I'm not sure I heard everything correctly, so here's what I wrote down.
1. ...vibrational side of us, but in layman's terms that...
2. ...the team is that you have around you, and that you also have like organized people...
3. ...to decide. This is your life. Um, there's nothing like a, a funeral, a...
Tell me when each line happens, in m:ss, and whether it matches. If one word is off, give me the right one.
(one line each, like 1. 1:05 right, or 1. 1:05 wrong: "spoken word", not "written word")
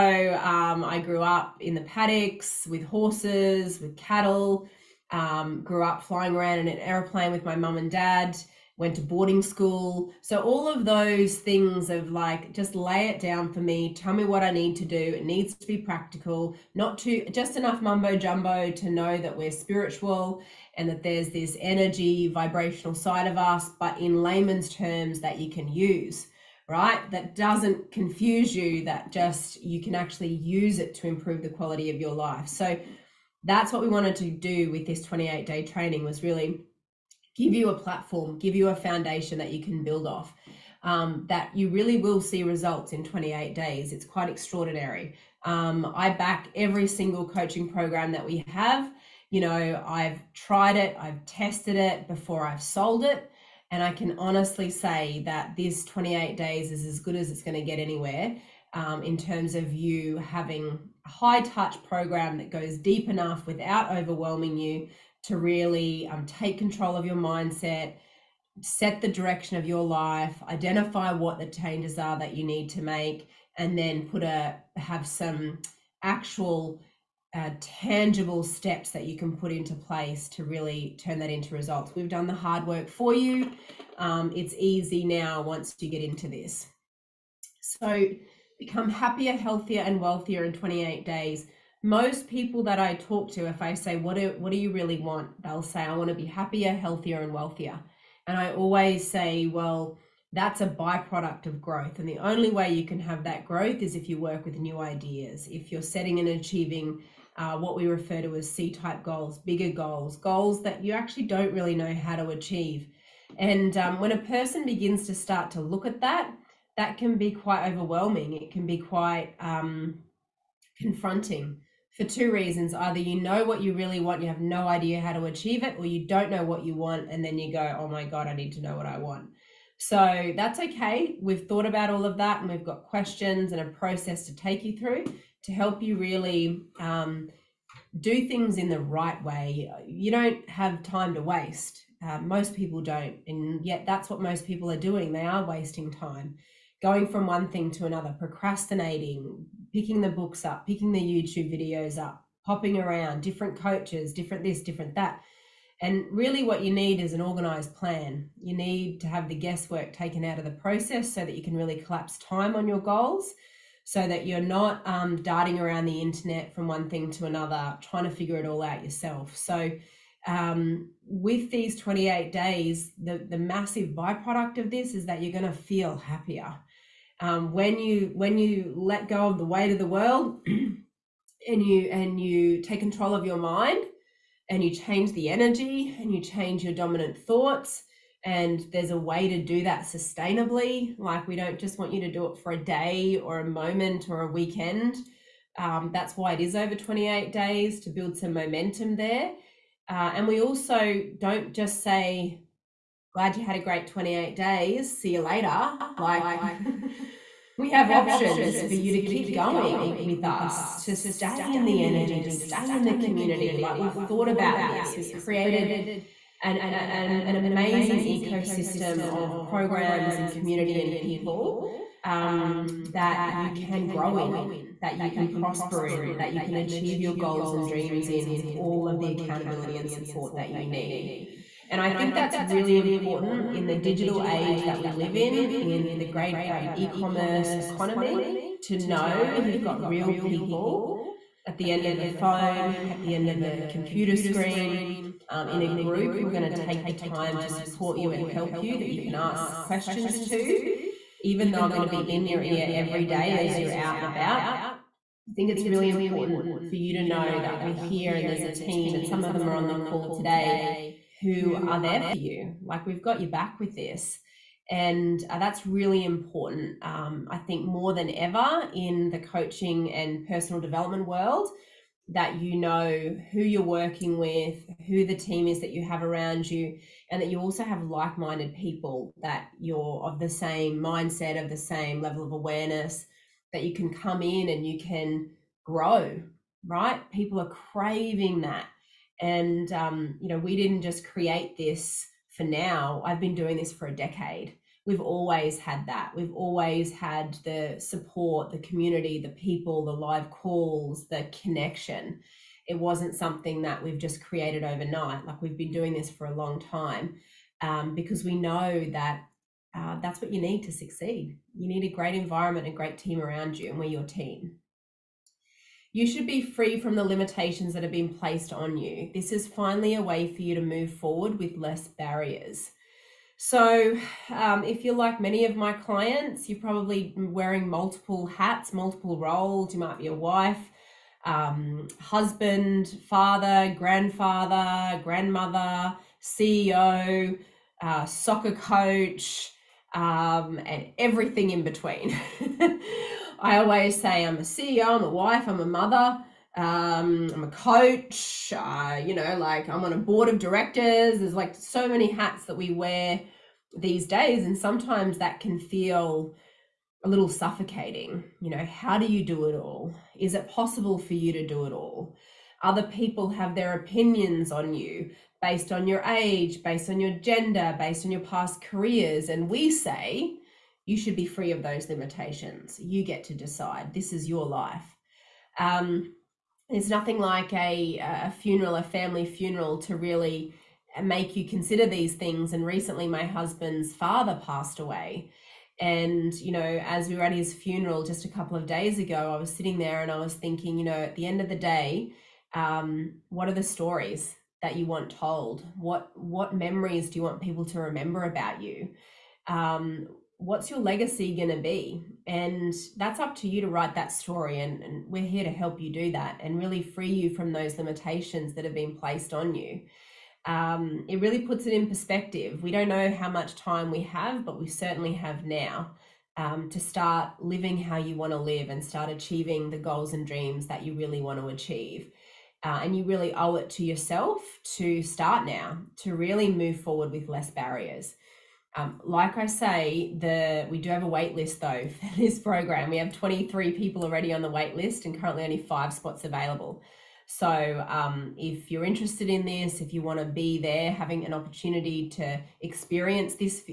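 1. 0:22 right
2. 4:35 wrong: "minded", not "organized"
3. 6:13 right.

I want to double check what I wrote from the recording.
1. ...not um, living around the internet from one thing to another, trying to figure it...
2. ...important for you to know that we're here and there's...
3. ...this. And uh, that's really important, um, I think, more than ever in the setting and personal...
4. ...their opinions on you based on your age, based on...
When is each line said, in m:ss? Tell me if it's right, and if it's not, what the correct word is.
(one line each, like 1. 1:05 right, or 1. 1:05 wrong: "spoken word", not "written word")
1. 2:44 wrong: "darting", not "living"
2. 4:15 right
3. 4:23 wrong: "coaching", not "setting"
4. 6:03 right.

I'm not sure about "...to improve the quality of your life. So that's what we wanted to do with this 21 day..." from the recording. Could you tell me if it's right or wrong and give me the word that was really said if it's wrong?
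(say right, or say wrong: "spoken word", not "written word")
wrong: "28", not "21".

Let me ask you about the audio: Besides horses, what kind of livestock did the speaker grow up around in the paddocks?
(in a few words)
cattle.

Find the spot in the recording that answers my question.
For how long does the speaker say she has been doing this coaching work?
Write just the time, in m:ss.
4:53.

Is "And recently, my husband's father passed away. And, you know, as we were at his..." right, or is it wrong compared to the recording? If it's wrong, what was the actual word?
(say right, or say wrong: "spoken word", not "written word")
right.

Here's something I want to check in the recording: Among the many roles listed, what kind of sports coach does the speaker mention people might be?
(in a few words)
soccer coach.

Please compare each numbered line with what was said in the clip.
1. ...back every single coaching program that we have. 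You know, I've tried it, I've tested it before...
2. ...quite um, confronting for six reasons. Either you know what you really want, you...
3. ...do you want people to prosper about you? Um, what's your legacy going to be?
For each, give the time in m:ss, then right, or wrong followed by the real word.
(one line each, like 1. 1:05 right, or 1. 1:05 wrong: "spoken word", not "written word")
1. 0:46 right
2. 1:58 wrong: "two", not "six"
3. 6:37 wrong: "remember", not "prosper".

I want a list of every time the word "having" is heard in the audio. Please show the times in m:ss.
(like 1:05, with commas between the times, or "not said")
1:00, 7:20.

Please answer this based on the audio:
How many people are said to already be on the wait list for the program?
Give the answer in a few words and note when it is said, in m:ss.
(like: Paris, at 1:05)
23, at 7:13.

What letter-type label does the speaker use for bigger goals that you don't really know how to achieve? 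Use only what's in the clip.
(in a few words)
C type goals.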